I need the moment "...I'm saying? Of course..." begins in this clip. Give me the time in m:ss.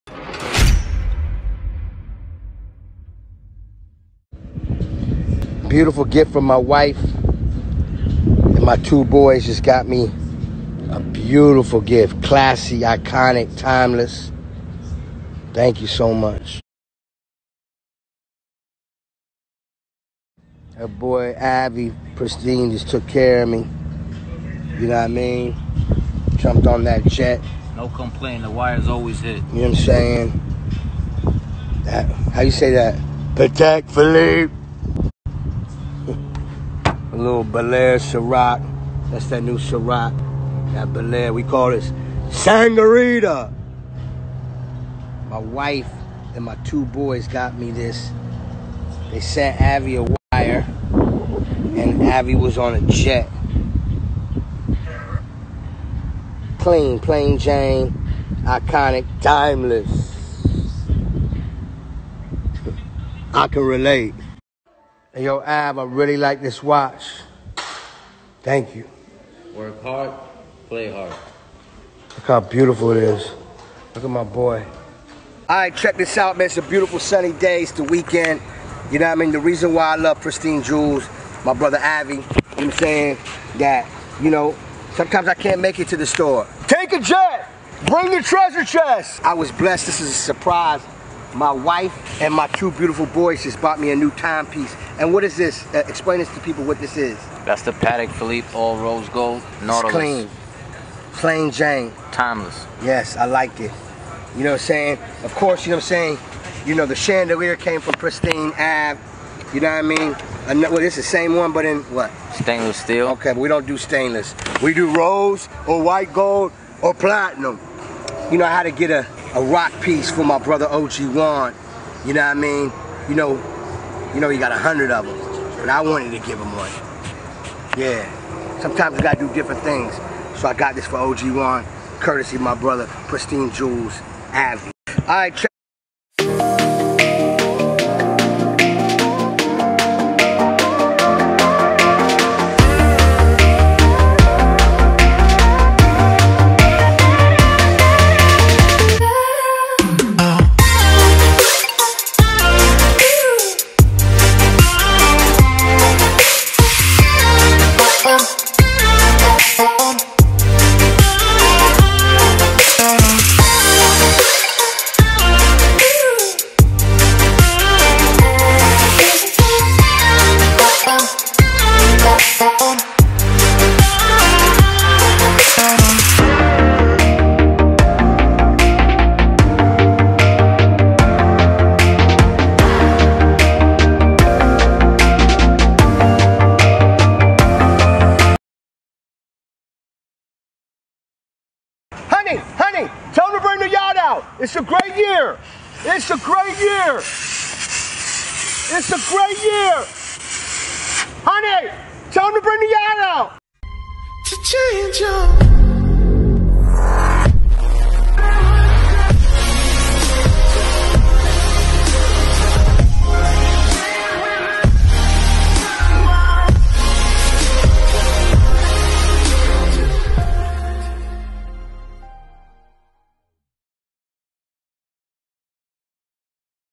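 1:44.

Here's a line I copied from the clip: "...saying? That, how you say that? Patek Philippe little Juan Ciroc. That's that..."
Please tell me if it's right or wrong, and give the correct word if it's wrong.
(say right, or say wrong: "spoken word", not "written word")
wrong: "Belaire", not "Juan".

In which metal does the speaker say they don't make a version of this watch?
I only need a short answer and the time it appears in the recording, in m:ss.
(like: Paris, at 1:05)
Stainless steel, at 1:52.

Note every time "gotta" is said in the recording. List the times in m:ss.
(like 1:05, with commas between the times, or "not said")
2:09.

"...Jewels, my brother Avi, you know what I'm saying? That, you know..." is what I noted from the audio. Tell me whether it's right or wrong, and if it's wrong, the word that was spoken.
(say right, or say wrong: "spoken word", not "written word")
right.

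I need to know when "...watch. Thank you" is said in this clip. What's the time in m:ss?
1:06.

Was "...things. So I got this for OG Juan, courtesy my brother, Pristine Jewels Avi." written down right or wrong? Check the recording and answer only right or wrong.
right.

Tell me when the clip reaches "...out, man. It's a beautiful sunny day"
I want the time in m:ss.
1:16.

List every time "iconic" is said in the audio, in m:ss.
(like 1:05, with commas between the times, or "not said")
0:12, 0:58.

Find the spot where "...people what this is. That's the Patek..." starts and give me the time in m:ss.
1:36.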